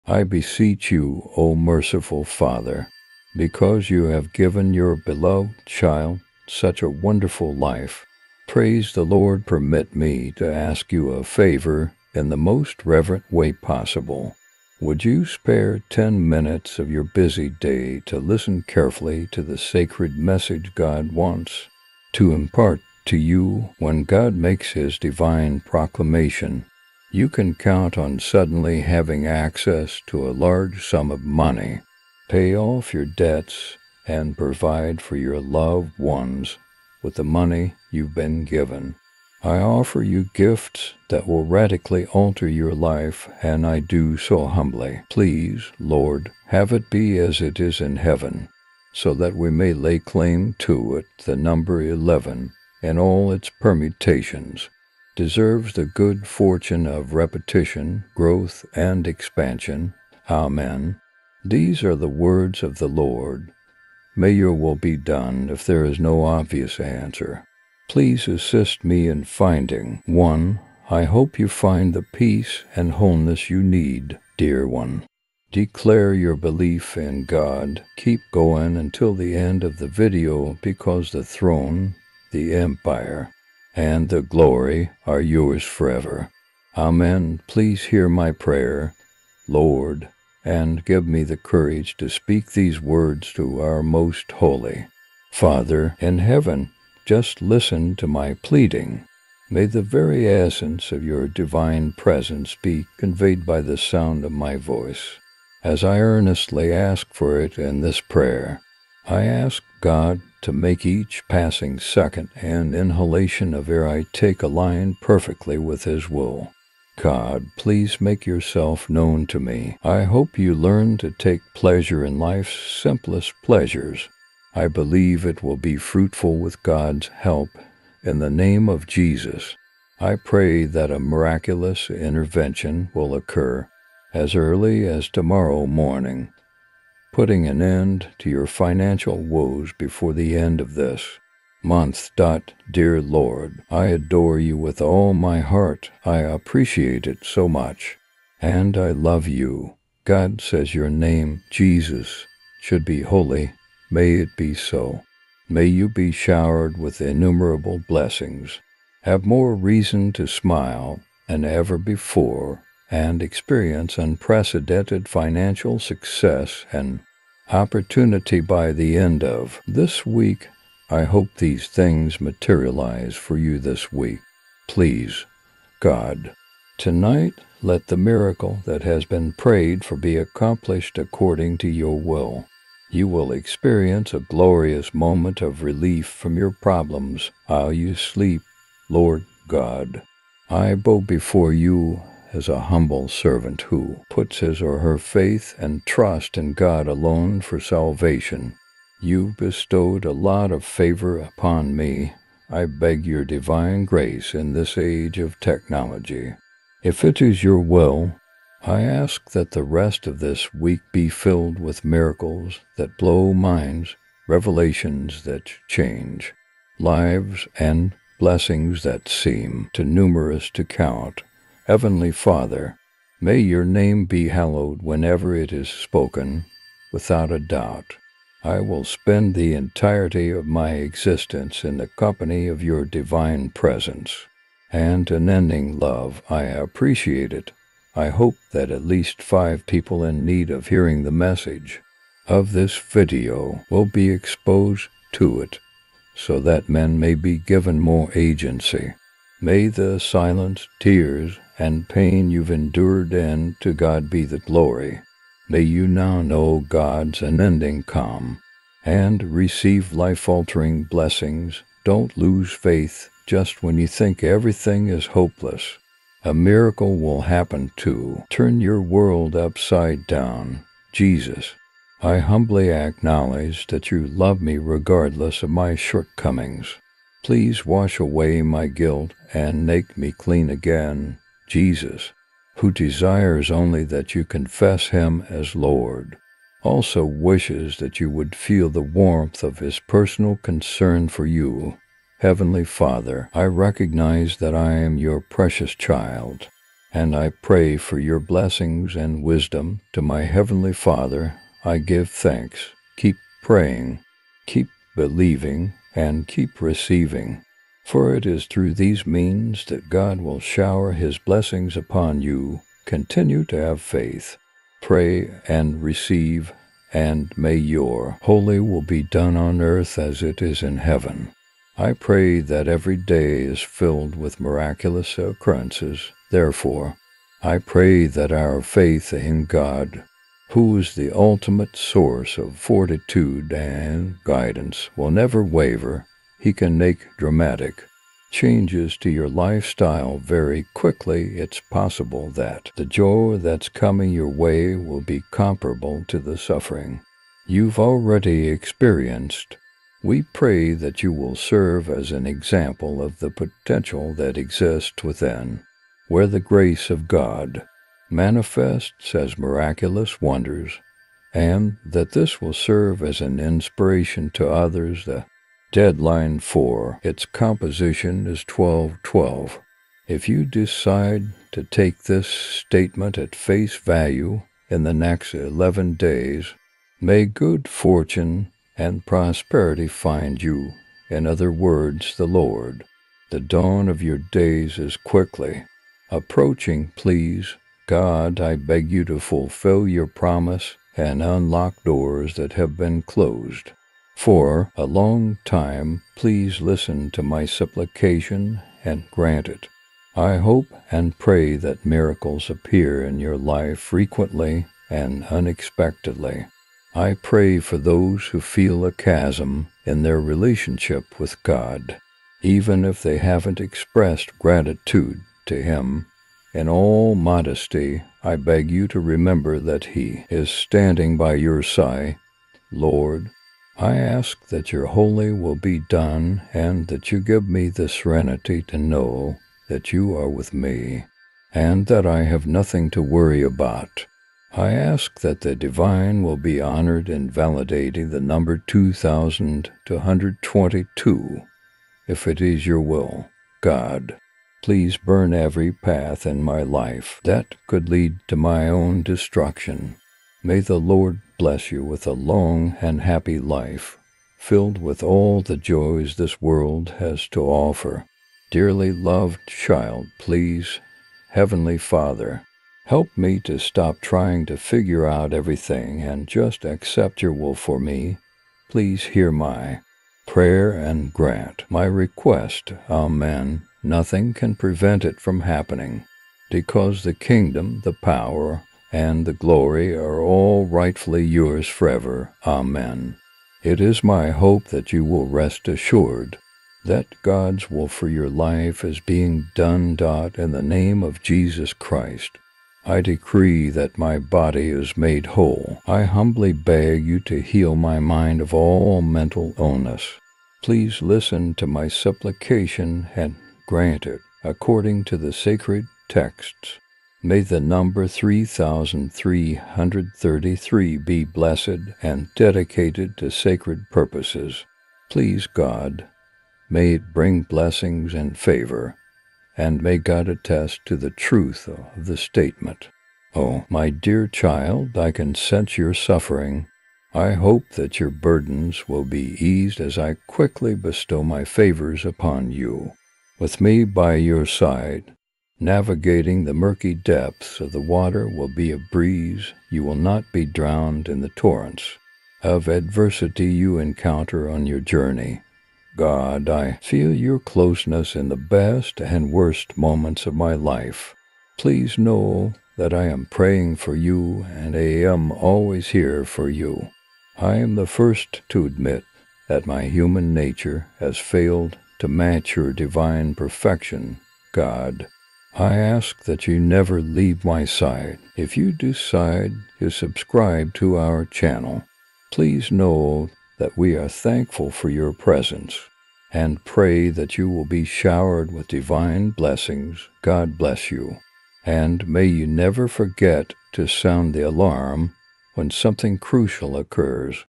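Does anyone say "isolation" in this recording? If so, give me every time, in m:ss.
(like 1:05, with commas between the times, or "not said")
not said.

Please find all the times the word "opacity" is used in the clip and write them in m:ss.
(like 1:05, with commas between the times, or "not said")
not said.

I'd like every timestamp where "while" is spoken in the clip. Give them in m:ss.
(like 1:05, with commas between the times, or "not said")
3:07.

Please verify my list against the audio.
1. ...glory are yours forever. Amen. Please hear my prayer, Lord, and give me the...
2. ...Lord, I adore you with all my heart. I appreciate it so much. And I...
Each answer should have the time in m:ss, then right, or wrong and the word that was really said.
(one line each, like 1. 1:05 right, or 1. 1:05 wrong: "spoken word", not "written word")
1. 1:24 right
2. 2:23 right.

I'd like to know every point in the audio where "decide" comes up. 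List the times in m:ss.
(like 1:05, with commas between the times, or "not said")
6:10, 9:28.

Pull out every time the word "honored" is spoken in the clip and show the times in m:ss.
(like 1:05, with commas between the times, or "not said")
7:16.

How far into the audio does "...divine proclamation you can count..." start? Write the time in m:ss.
0:24.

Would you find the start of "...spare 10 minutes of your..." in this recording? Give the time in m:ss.
0:15.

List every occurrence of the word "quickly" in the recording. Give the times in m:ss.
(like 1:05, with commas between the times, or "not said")
5:40, 6:24, 8:50.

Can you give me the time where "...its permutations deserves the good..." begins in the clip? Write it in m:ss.
0:53.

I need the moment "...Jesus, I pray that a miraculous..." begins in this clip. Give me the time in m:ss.
2:08.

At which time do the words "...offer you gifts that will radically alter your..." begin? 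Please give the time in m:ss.
0:39.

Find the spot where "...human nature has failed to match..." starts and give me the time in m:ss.
9:19.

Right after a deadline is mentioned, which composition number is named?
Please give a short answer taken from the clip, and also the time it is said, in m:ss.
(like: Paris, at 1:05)
1212, at 6:08.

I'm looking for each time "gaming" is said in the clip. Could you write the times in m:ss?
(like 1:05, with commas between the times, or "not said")
not said.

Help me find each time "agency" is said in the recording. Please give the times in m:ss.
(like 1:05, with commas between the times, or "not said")
4:08.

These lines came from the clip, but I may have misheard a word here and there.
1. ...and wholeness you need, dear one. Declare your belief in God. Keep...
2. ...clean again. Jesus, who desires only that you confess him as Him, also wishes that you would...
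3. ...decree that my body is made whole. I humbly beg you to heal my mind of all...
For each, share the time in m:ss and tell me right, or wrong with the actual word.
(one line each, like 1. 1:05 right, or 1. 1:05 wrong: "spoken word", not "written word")
1. 1:12 right
2. 4:40 wrong: "Lord", not "Him"
3. 8:13 right.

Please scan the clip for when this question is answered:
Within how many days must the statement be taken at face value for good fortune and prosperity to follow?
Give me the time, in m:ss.
6:15.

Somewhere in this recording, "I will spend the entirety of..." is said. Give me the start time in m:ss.
3:48.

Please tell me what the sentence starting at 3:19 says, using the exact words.
You bestowed a lot of favor upon me.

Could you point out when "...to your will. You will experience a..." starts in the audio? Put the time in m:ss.
3:01.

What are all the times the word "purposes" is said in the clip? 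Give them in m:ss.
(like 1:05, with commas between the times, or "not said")
8:33.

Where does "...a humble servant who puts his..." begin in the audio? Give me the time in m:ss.
3:12.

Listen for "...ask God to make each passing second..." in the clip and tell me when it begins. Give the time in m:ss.
1:49.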